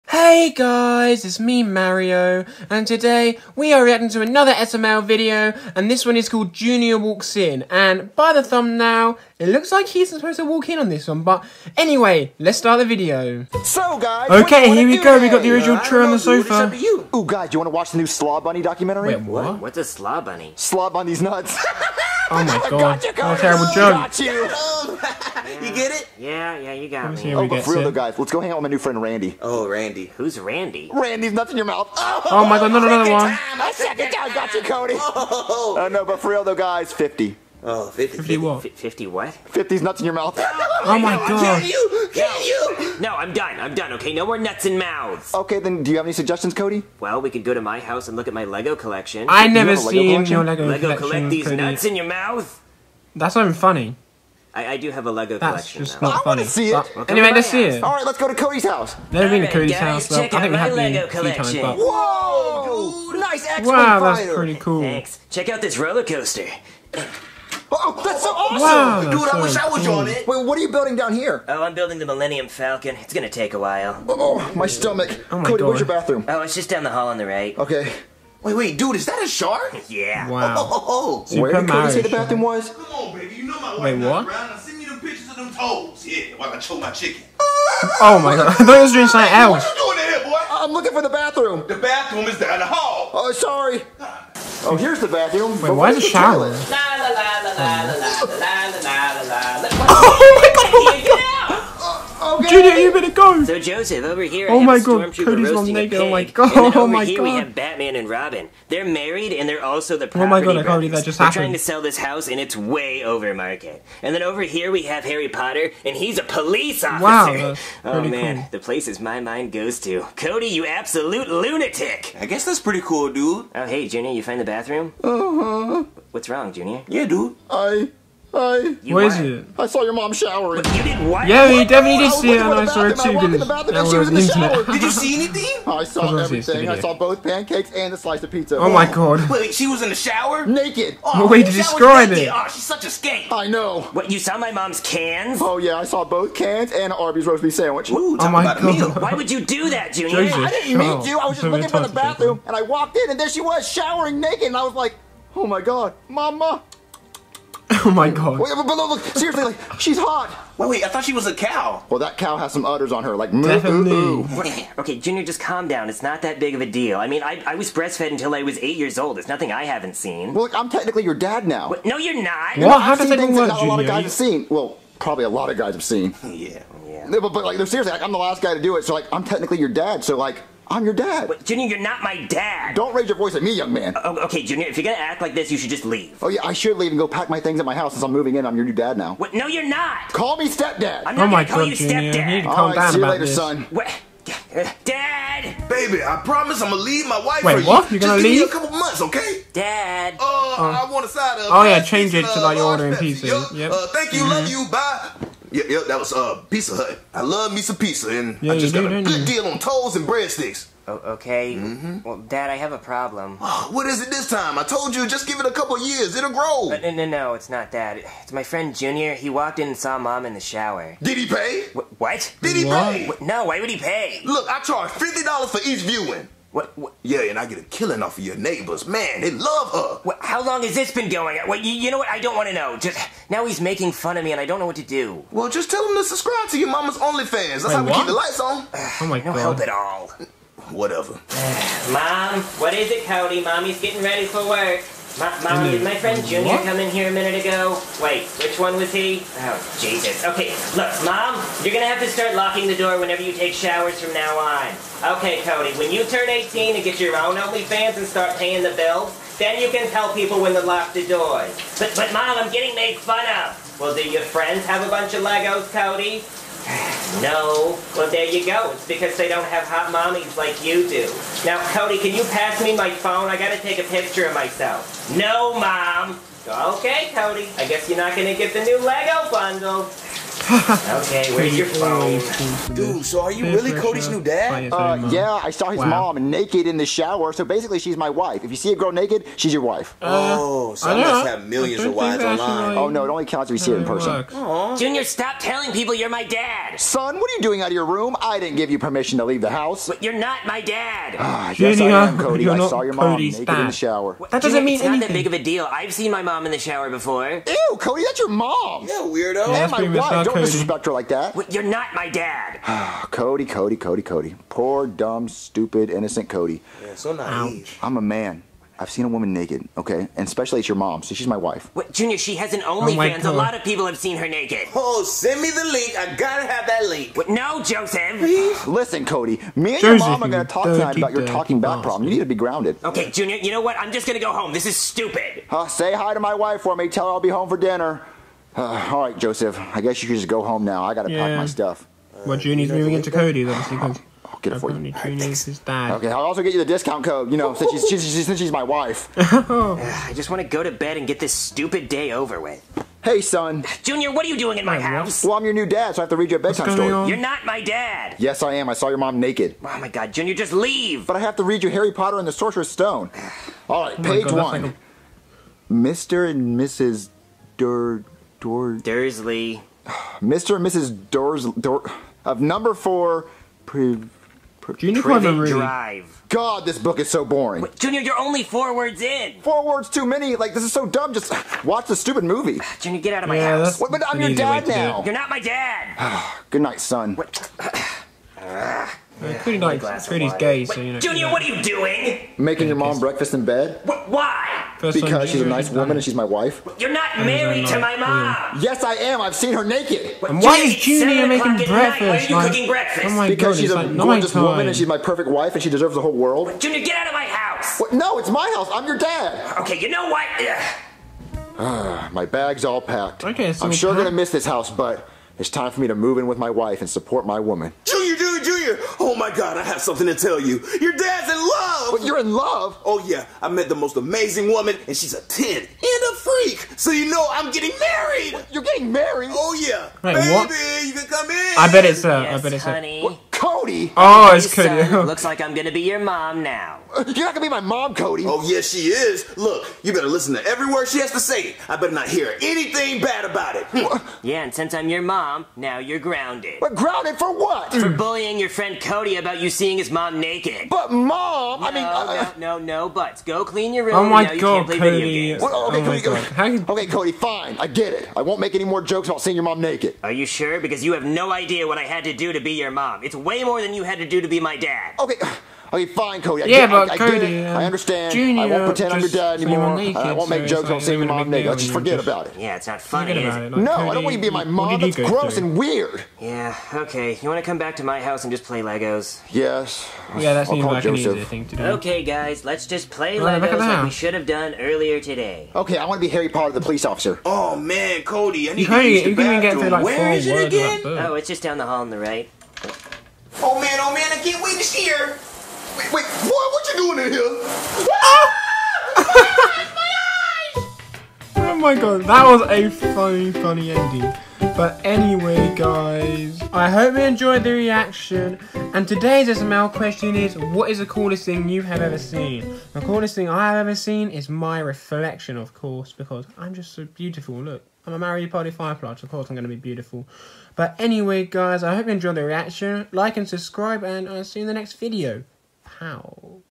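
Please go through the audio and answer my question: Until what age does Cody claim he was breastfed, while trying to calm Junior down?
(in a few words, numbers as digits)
8.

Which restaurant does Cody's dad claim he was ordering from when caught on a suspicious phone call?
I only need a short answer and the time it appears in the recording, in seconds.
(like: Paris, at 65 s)
Pizza Hut, at 206 s.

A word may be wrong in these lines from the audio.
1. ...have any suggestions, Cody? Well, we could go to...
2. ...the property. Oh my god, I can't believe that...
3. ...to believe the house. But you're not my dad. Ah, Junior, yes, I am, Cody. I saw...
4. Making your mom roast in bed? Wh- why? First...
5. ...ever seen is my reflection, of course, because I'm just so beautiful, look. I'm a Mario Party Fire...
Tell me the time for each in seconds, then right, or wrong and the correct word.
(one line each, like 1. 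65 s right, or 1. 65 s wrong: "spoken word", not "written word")
1. 45 s right
2. 109 s right
3. 299 s wrong: "leave", not "believe"
4. 392 s wrong: "breakfast", not "roast"
5. 513 s right.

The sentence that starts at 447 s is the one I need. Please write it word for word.
For bullying your friend Cody about you seeing his mom naked.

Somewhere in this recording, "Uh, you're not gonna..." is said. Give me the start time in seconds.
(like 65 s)
436 s.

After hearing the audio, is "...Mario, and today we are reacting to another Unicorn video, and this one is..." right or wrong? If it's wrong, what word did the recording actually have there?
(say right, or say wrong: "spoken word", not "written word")
wrong: "SML", not "Unicorn".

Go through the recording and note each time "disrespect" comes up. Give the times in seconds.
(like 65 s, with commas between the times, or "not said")
310 s.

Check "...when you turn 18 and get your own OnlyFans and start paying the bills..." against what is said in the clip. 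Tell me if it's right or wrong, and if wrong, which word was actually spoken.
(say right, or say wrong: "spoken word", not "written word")
right.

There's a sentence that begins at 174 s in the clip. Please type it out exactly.
Well, probably a lot of guys have seen.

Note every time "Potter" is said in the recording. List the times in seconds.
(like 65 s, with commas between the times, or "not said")
115 s, 361 s, 486 s.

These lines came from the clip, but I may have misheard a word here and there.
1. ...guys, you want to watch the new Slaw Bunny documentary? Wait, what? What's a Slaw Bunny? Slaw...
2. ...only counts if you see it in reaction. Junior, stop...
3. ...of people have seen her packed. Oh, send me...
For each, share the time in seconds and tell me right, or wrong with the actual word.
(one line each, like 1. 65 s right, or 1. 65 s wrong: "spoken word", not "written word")
1. 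17 s right
2. 293 s wrong: "person", not "reaction"
3. 323 s wrong: "naked", not "packed".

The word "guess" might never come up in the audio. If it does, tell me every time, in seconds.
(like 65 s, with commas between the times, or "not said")
122 s, 277 s, 339 s.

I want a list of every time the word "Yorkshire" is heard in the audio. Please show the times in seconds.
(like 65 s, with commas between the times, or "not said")
not said.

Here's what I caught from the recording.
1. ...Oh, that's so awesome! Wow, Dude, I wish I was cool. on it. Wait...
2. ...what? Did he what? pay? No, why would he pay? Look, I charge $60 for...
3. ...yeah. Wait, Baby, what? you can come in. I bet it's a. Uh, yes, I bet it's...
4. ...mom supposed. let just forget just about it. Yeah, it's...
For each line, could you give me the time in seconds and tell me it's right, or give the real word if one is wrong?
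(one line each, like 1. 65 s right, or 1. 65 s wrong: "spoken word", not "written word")
1. 67 s right
2. 221 s wrong: "50", not "60"
3. 429 s right
4. 471 s wrong: "naked", not "supposed".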